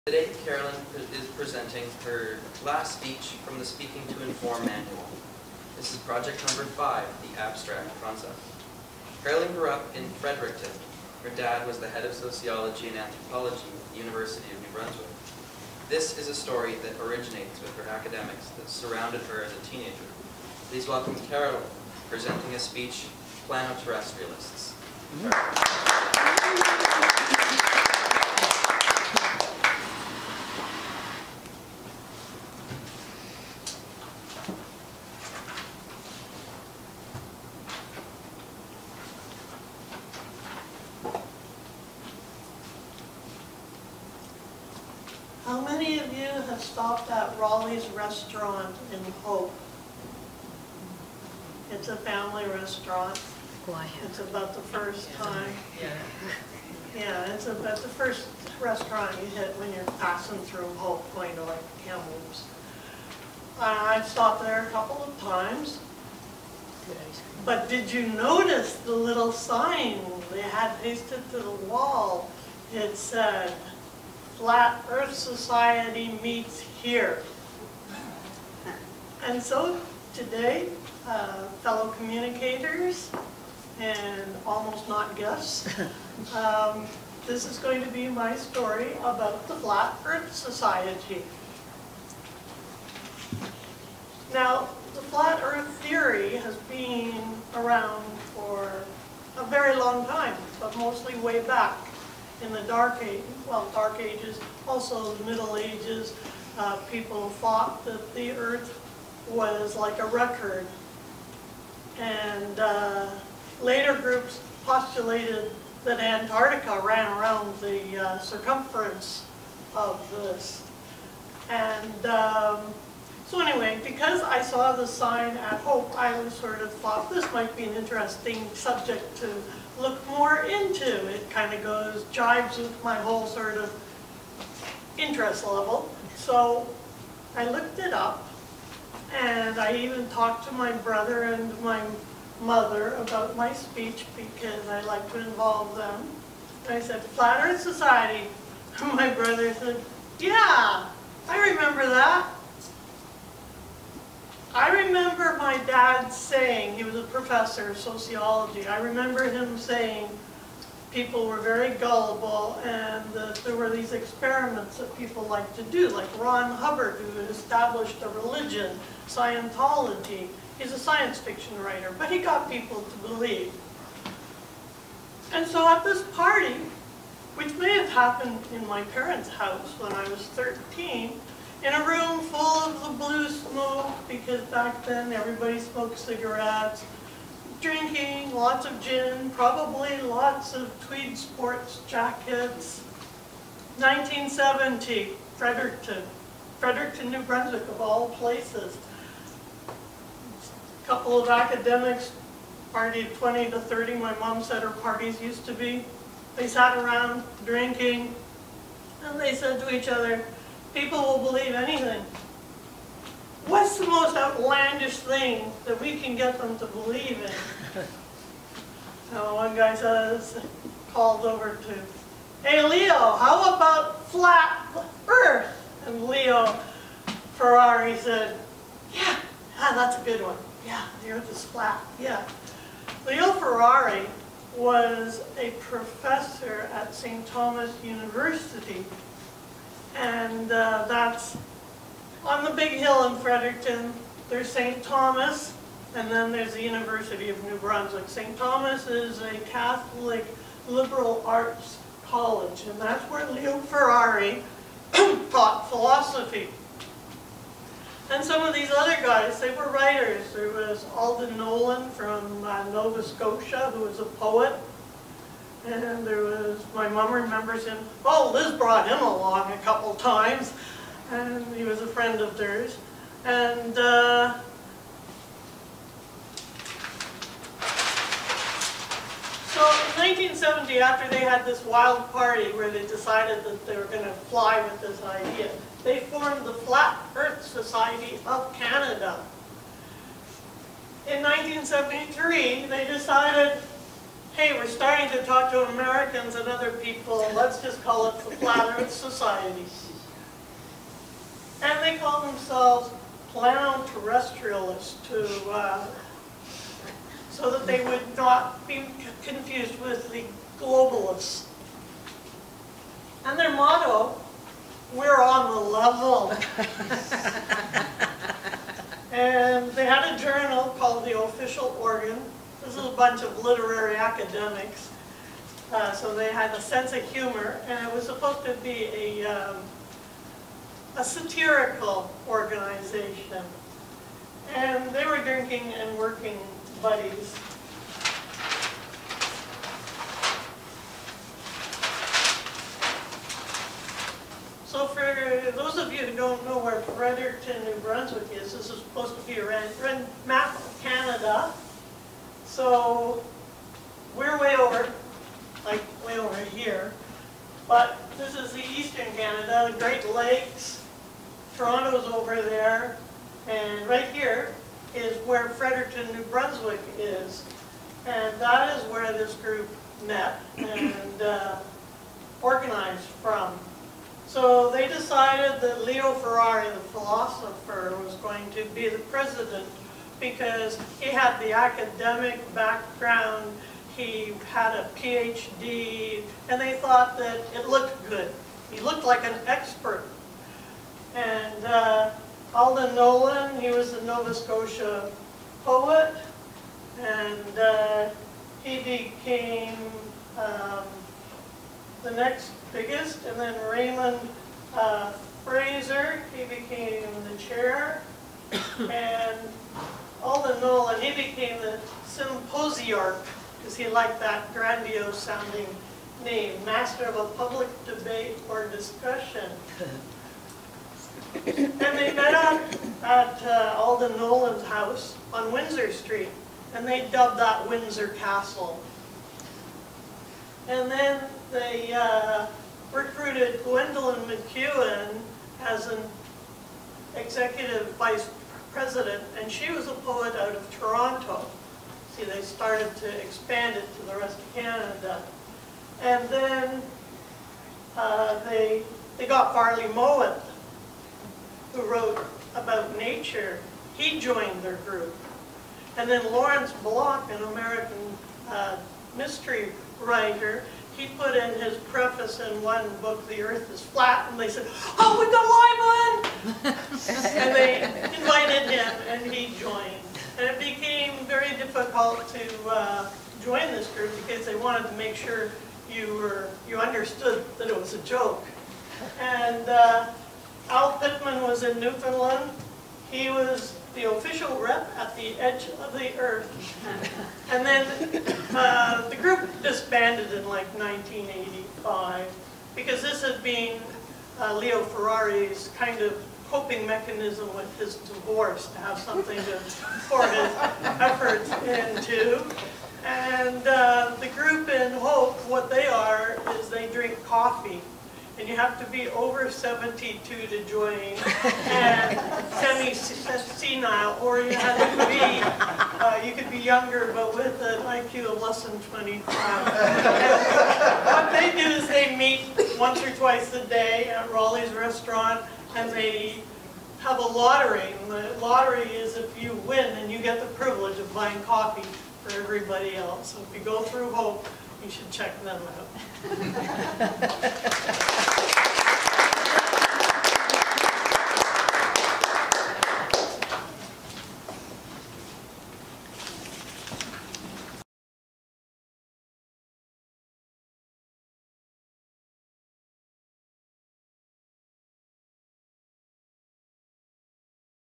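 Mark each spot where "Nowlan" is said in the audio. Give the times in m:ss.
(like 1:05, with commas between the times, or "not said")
4:21, 6:32, 7:04.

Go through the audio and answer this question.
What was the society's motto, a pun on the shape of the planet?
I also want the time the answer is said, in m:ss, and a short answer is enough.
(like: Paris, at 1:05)
We're on the level, at 5:14.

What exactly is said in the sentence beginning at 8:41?
what they do is they meet once or twice a day at Rolly's restaurant, and they have a lottery.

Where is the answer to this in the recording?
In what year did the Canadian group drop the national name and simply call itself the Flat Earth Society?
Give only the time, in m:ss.
4:51.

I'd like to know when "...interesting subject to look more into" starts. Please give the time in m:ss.
2:07.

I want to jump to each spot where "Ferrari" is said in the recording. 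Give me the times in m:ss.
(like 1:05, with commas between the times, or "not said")
3:47, 3:53, 4:13, 6:16, 8:14.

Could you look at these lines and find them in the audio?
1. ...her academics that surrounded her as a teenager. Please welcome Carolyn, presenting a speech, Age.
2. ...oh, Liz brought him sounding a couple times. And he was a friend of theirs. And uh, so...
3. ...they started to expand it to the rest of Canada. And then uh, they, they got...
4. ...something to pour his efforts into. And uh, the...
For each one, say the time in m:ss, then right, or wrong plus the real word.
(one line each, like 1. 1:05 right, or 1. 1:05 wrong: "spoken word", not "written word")
1. 0:17 wrong: "Planoterrestrialists", not "Age"
2. 4:28 wrong: "along", not "sounding"
3. 7:22 right
4. 8:18 right.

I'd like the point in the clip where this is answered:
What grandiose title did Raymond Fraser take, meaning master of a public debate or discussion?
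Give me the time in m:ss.
6:52.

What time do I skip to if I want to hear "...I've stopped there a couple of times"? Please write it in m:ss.
1:03.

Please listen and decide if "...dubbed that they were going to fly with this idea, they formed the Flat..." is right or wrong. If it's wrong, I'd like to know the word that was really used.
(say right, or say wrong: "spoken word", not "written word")
wrong: "decided", not "dubbed".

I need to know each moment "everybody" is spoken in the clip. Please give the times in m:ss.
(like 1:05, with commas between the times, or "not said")
3:05, 8:52.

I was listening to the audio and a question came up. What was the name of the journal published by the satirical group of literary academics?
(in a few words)
the Official Organ.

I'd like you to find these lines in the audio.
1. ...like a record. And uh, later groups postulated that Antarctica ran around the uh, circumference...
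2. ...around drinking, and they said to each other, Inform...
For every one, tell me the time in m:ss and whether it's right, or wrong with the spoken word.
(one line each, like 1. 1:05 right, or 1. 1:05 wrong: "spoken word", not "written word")
1. 1:49 right
2. 3:26 wrong: "People", not "Inform".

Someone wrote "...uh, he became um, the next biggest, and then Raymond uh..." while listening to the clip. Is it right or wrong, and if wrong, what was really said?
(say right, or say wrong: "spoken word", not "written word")
right.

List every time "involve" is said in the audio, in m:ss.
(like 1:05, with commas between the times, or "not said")
2:25.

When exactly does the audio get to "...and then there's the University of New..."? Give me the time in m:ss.
4:05.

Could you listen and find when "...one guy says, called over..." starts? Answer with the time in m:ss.
3:39.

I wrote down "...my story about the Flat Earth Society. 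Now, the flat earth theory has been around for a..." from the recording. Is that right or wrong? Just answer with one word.
right.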